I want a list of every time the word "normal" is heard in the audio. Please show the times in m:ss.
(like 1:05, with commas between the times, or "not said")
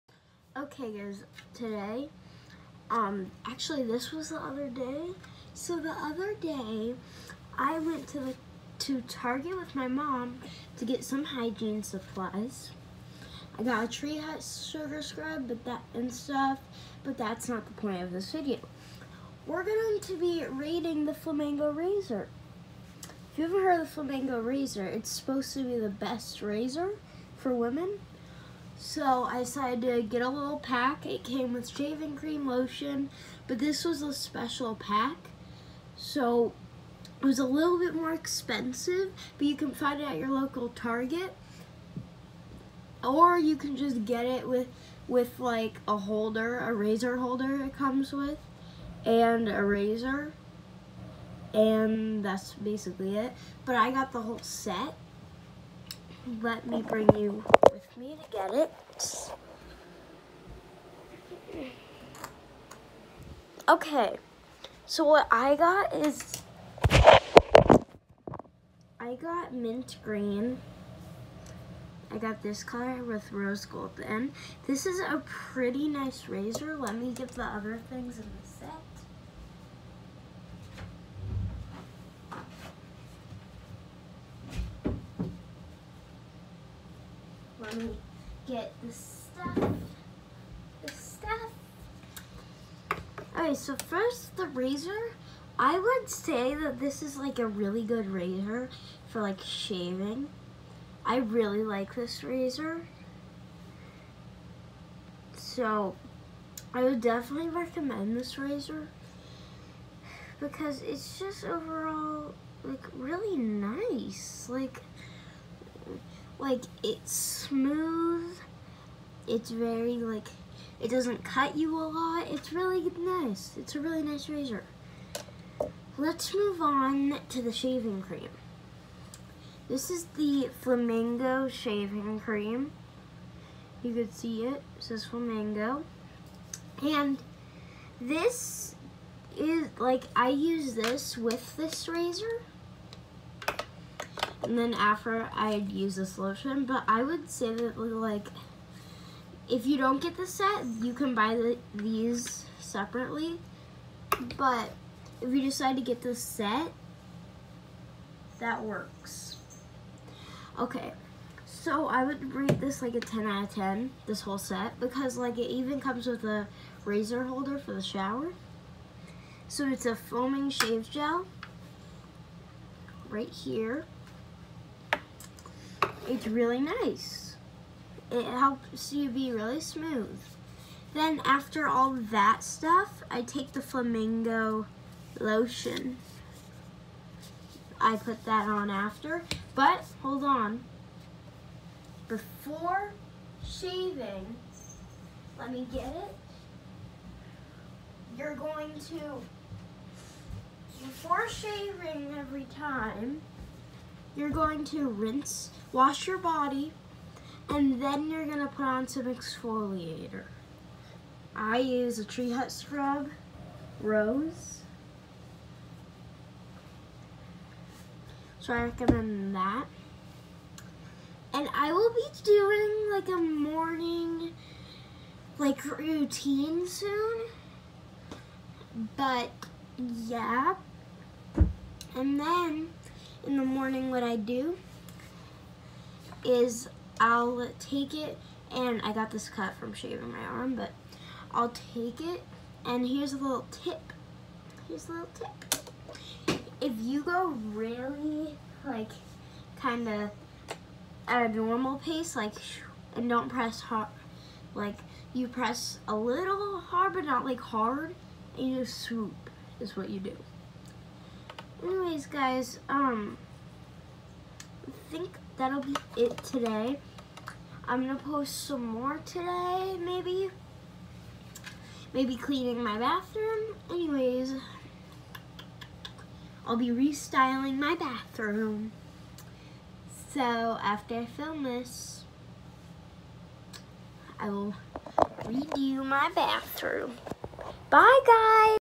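4:11.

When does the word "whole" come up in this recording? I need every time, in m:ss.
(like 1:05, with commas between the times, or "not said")
0:54, 2:44.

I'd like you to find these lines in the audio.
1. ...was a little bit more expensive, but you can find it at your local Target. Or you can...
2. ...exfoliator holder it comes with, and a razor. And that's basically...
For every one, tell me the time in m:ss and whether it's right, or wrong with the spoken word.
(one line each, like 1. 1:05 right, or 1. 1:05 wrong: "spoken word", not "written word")
1. 0:37 right
2. 0:46 wrong: "razor", not "exfoliator".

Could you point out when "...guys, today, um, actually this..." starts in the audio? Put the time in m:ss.
0:00.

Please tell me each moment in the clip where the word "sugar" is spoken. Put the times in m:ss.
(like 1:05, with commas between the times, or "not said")
0:14.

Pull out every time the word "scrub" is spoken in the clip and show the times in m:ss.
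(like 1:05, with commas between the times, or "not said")
0:15, 3:32.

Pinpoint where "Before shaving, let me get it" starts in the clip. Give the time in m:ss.
3:12.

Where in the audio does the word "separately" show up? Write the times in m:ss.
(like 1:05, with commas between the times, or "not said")
2:32.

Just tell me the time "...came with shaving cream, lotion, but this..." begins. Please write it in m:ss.
0:31.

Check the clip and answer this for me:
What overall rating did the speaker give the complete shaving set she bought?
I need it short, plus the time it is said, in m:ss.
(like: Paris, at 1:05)
10 out of 10, at 2:42.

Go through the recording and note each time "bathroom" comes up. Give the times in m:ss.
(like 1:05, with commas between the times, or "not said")
4:32, 4:37, 4:46.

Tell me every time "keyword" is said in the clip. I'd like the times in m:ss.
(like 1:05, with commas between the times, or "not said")
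not said.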